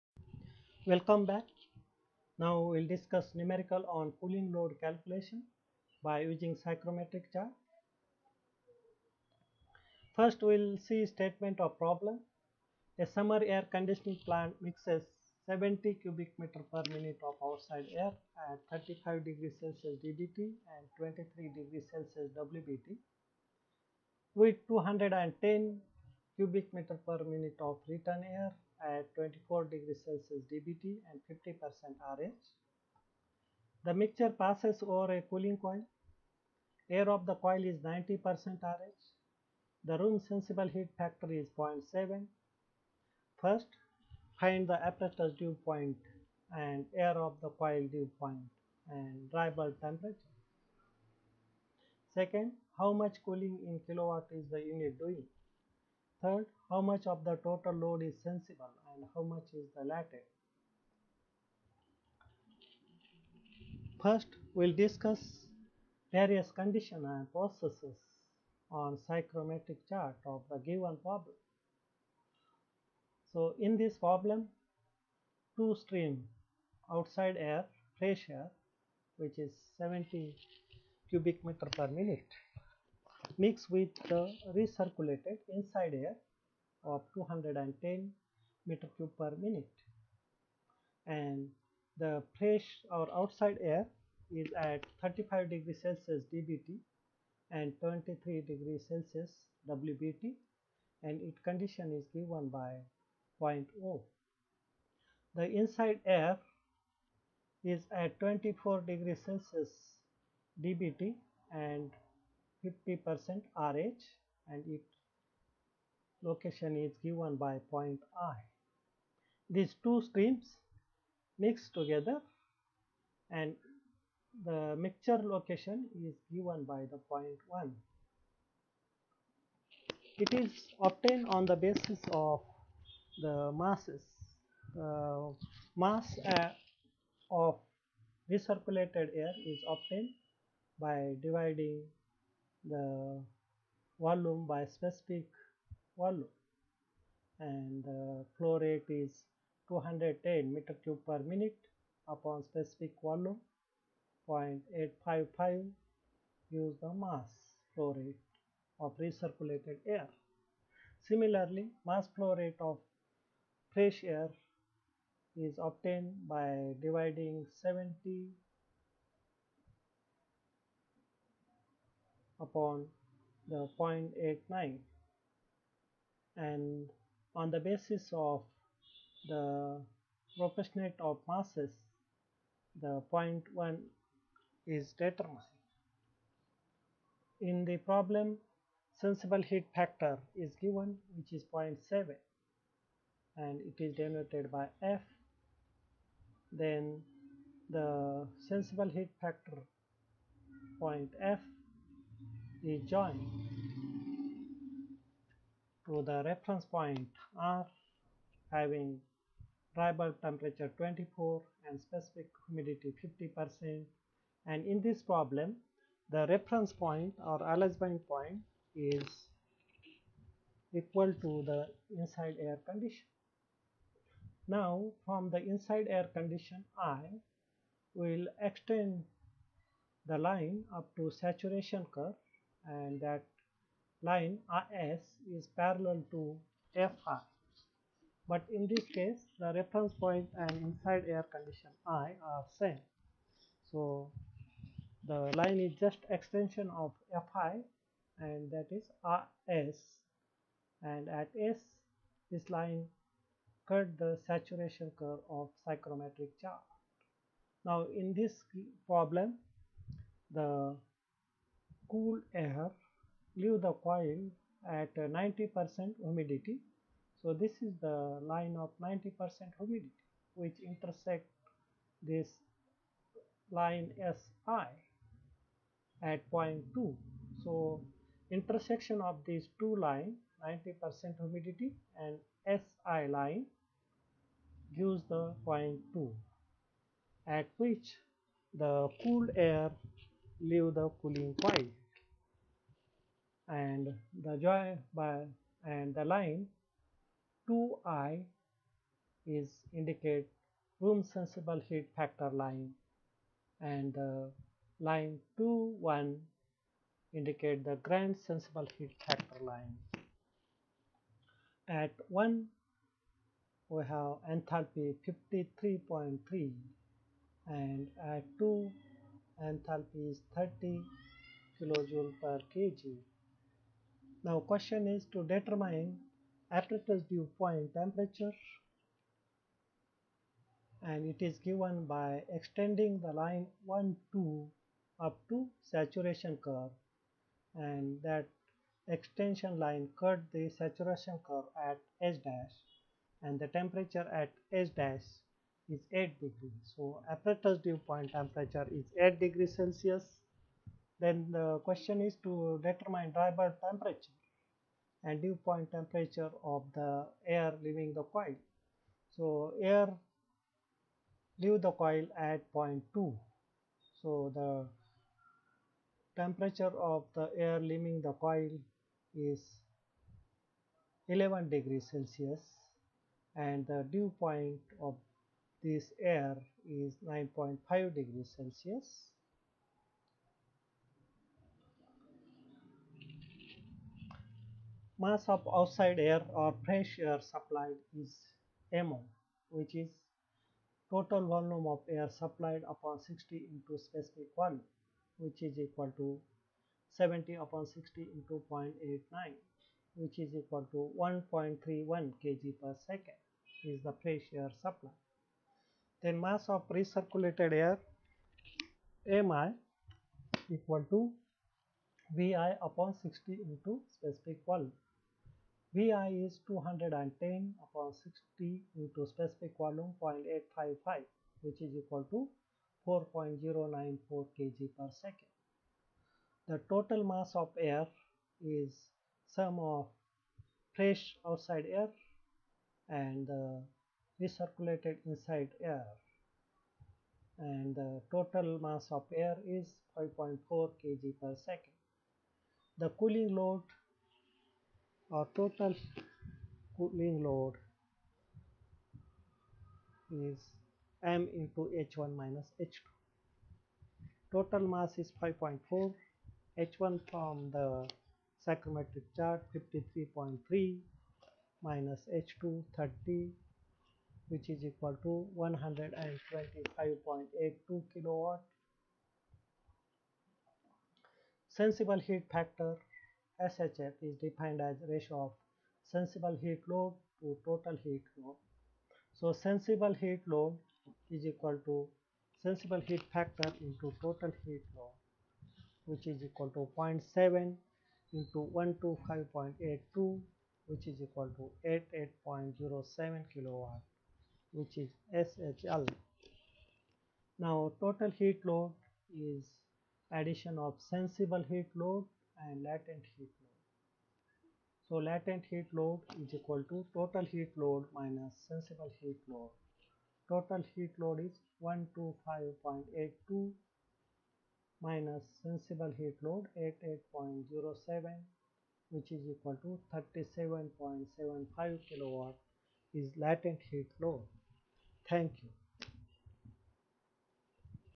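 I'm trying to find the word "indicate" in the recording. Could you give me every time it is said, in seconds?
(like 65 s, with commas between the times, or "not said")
299 s, 307 s.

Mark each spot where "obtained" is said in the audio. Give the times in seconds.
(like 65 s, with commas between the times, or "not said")
130 s, 139 s, 165 s.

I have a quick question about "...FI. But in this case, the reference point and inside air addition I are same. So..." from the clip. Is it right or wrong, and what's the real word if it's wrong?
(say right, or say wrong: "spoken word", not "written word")
wrong: "condition", not "addition".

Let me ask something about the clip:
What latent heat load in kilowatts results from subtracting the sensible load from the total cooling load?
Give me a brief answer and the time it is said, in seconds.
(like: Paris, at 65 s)
37.75 kilowatt, at 519 s.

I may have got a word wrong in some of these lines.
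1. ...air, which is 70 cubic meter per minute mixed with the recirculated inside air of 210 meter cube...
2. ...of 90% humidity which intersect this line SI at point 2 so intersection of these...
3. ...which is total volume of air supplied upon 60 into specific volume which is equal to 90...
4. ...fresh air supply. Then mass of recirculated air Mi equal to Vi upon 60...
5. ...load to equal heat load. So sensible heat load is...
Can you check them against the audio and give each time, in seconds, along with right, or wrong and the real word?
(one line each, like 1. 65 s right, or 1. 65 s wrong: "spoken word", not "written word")
1. 78 s right
2. 268 s right
3. 389 s wrong: "70", not "90"
4. 404 s right
5. 476 s wrong: "total", not "equal".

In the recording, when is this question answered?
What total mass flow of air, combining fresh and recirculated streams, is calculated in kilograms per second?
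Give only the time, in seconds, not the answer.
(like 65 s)
439 s.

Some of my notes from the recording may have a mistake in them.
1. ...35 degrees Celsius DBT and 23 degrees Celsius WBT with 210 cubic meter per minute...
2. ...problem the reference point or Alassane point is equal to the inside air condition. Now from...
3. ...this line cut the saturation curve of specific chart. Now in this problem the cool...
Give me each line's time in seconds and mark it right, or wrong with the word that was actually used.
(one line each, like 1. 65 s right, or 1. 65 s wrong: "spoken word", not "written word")
1. 18 s right
2. 215 s right
3. 252 s wrong: "psychrometric", not "specific".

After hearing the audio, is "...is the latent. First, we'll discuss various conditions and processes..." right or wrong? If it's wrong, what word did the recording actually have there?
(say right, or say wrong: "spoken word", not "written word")
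right.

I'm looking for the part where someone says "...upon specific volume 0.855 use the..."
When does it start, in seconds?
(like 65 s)
152 s.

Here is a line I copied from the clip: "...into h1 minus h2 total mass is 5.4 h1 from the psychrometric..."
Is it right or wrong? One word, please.
right.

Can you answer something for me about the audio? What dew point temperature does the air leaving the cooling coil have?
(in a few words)
9.5 degrees Celsius.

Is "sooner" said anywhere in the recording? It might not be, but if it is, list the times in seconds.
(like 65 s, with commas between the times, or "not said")
not said.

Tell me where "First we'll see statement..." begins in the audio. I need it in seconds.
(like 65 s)
10 s.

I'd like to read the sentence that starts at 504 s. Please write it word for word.
So latent heat load is equal to total heat load minus sensible heat load.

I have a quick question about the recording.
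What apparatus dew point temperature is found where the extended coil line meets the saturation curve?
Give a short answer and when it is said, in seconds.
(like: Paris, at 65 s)
8 degrees Celsius, at 348 s.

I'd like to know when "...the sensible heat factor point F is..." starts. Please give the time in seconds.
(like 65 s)
197 s.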